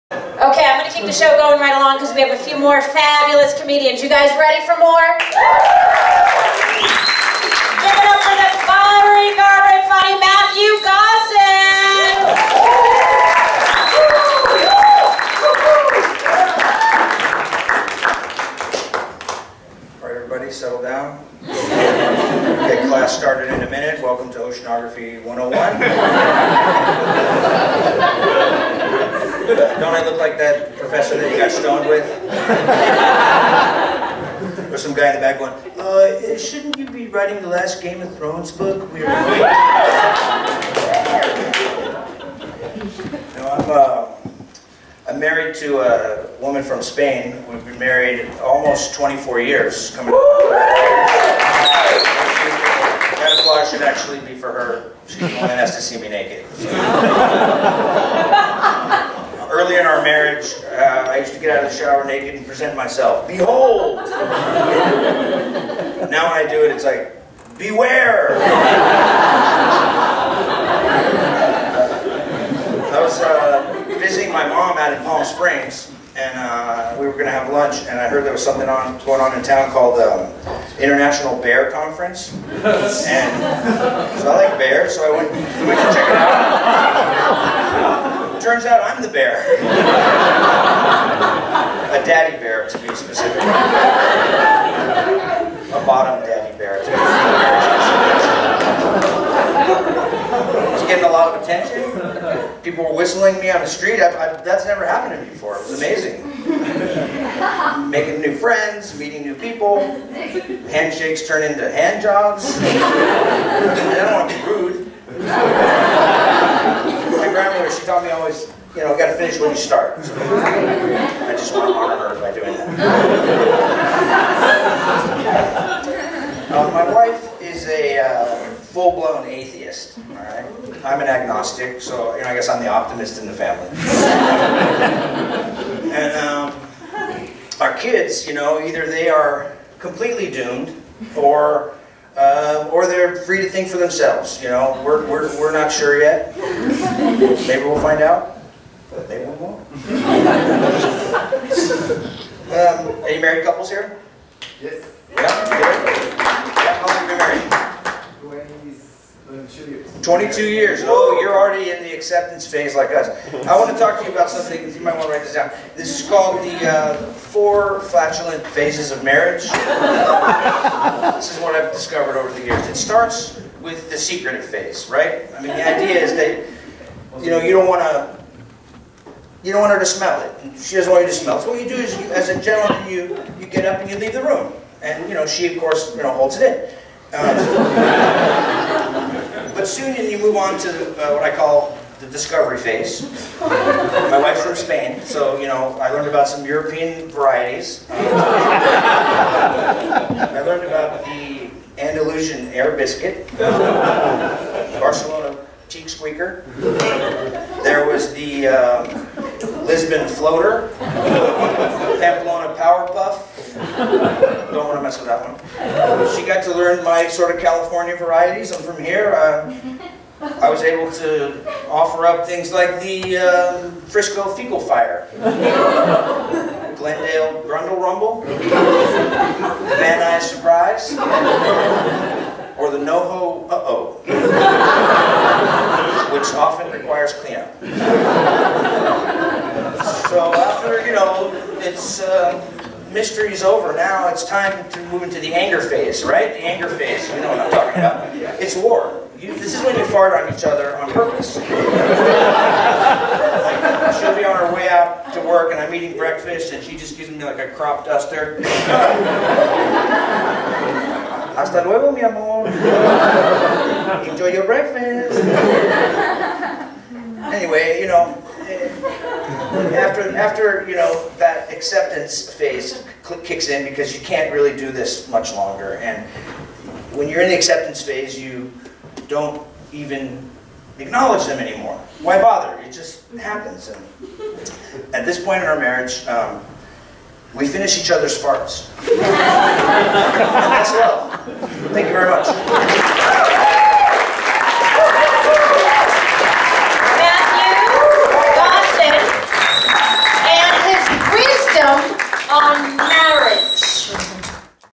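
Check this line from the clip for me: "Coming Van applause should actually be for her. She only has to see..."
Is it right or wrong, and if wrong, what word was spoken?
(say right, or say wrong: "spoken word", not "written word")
wrong: "That", not "Van".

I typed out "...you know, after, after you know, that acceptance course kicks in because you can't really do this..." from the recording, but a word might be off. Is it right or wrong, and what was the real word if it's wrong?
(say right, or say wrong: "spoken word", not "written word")
wrong: "phase", not "course".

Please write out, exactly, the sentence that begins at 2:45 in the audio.
This is called the uh, four flatulent phases of marriage.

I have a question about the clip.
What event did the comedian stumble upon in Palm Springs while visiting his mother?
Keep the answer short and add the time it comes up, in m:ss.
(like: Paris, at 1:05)
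International Bear Conference, at 1:20.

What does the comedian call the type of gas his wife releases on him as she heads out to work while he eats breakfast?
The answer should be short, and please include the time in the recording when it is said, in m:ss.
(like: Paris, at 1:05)
crop duster, at 4:17.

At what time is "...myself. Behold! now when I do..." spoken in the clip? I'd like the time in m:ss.
1:02.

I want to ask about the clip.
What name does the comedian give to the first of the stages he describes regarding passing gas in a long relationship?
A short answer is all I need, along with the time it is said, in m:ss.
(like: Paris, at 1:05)
secretive phase, at 2:53.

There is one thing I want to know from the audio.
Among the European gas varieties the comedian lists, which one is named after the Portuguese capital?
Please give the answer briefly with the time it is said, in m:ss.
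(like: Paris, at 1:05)
Lisbon floater, at 3:29.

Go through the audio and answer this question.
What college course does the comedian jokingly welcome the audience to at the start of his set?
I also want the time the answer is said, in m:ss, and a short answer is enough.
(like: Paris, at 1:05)
Oceanography 101, at 0:24.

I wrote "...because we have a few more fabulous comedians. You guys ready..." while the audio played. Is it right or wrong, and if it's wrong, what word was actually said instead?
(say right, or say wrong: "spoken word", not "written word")
right.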